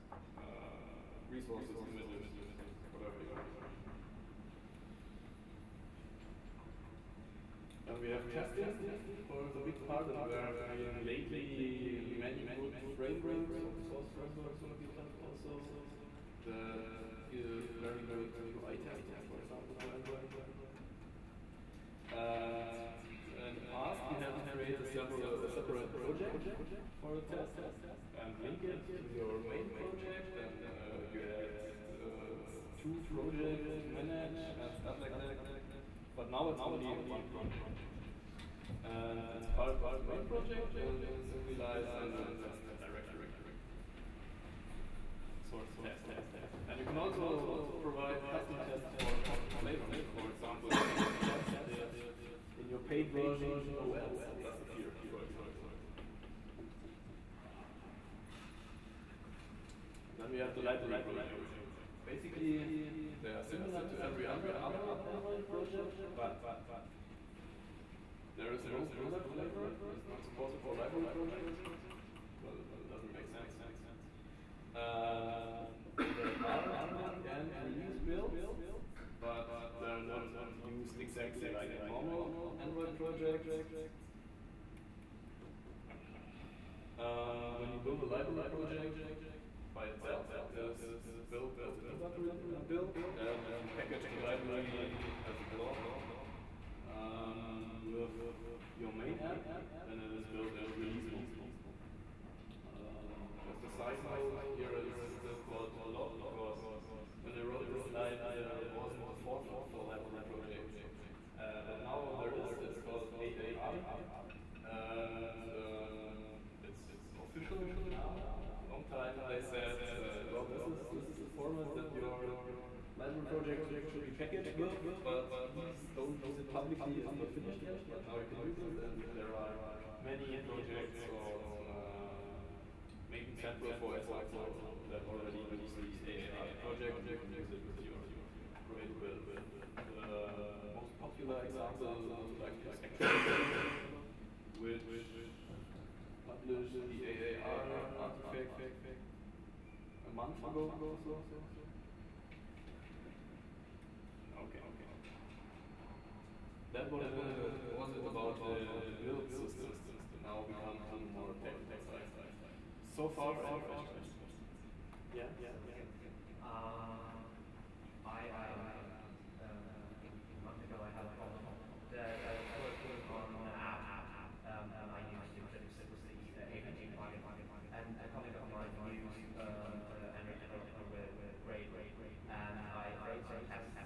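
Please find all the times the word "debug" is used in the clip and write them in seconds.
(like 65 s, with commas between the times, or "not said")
76 s, 91 s.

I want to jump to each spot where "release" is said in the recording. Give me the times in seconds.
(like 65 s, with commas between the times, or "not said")
77 s, 100 s.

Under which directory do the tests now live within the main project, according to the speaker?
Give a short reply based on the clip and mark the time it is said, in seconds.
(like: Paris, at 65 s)
source test, at 45 s.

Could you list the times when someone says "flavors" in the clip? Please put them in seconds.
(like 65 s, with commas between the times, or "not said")
49 s, 69 s.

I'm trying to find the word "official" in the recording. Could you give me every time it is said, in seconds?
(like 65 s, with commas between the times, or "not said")
117 s.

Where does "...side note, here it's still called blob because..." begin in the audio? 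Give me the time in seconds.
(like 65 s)
103 s.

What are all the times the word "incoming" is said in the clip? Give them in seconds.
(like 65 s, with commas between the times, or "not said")
not said.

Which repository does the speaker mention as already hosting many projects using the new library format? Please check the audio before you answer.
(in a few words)
Maven Central.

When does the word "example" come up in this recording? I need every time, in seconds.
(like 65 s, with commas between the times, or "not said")
19 s, 50 s, 55 s, 133 s, 141 s.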